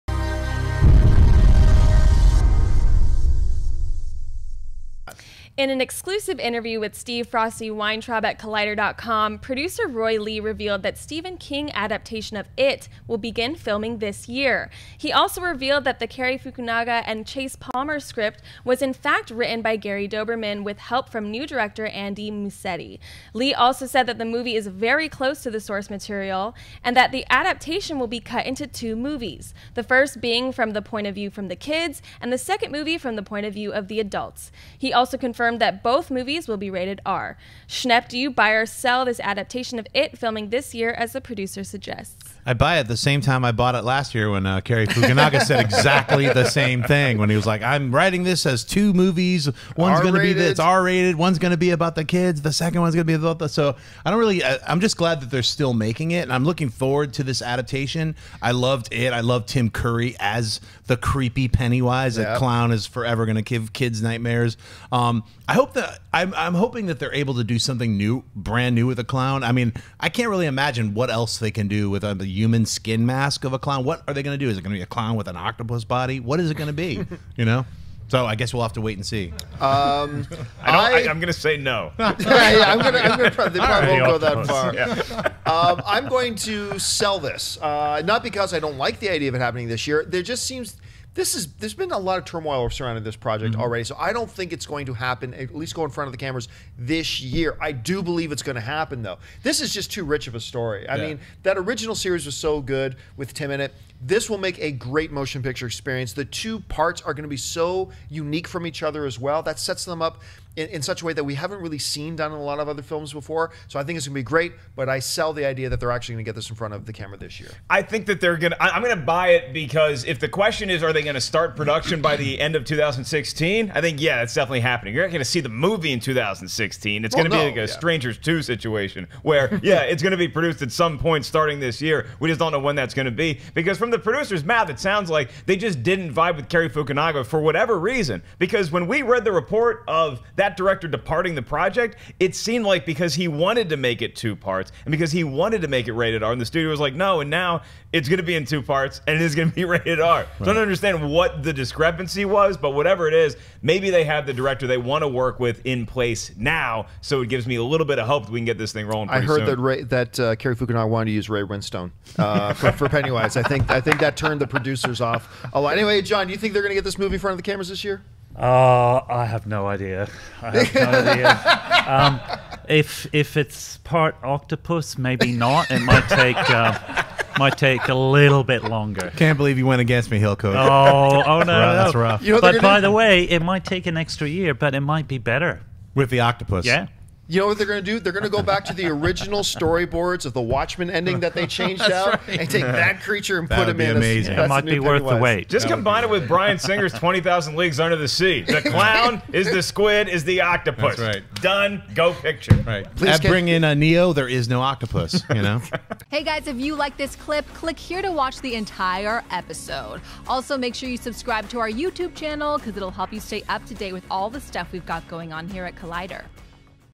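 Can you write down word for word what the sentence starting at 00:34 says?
He also confirmed confirmed that both movies will be rated R.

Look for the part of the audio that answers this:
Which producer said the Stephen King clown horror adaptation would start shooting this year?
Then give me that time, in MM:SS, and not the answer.
00:09.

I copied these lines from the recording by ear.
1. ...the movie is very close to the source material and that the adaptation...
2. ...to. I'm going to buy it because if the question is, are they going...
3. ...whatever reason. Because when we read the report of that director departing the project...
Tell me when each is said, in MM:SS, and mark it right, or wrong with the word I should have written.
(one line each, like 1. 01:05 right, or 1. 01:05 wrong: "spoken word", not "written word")
1. 00:24 right
2. 01:58 right
3. 02:17 right.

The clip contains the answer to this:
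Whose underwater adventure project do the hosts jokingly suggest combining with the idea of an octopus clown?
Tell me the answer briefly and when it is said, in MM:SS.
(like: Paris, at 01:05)
Bryan Singer, at 03:16.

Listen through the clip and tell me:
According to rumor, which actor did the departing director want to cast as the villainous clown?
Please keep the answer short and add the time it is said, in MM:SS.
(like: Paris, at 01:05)
Ray Winstone, at 02:41.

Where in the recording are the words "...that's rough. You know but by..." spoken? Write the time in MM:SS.
03:01.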